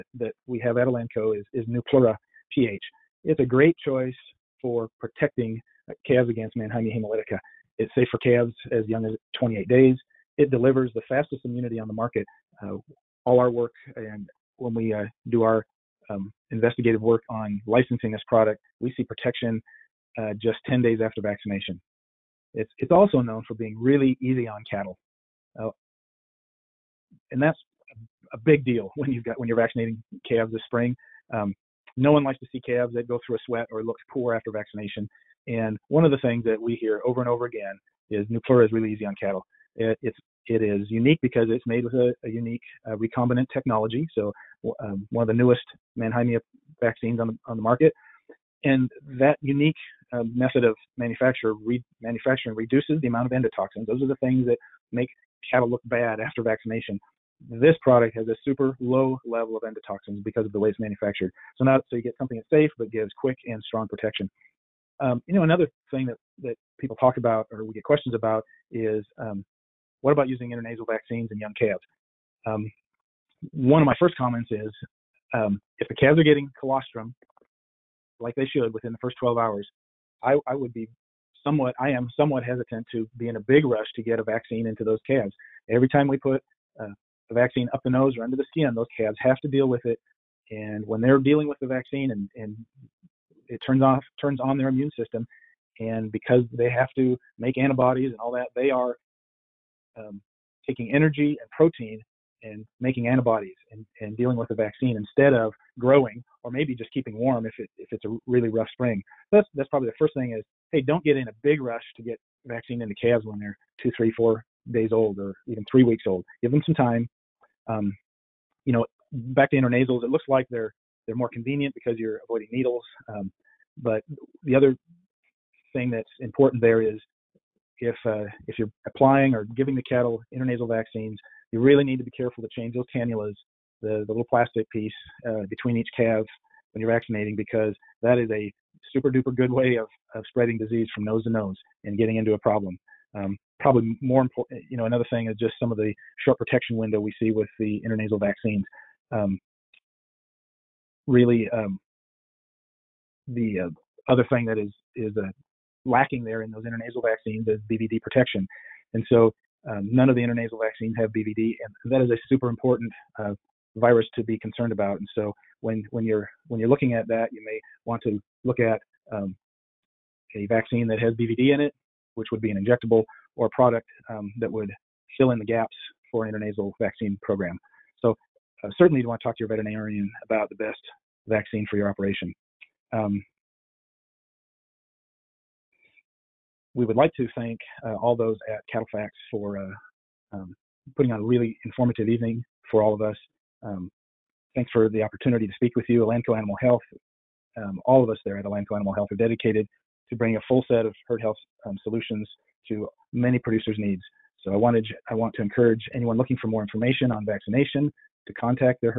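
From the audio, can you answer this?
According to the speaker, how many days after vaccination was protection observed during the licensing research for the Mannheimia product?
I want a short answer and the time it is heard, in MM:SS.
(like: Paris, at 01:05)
10 days, at 00:20.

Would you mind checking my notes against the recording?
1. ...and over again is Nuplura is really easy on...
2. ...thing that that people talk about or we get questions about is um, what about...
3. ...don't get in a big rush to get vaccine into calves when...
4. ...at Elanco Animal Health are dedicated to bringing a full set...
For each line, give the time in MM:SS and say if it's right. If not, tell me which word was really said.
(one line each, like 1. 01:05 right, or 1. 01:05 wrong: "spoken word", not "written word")
1. 00:37 right
2. 01:05 right
3. 01:50 right
4. 03:18 right.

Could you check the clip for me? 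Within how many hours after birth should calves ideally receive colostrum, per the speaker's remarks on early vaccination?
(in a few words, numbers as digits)
12 hours.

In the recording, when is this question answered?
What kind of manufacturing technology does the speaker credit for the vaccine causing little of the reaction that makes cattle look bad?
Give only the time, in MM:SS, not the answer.
00:42.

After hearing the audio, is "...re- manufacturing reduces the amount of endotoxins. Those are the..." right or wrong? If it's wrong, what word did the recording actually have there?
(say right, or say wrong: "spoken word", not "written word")
right.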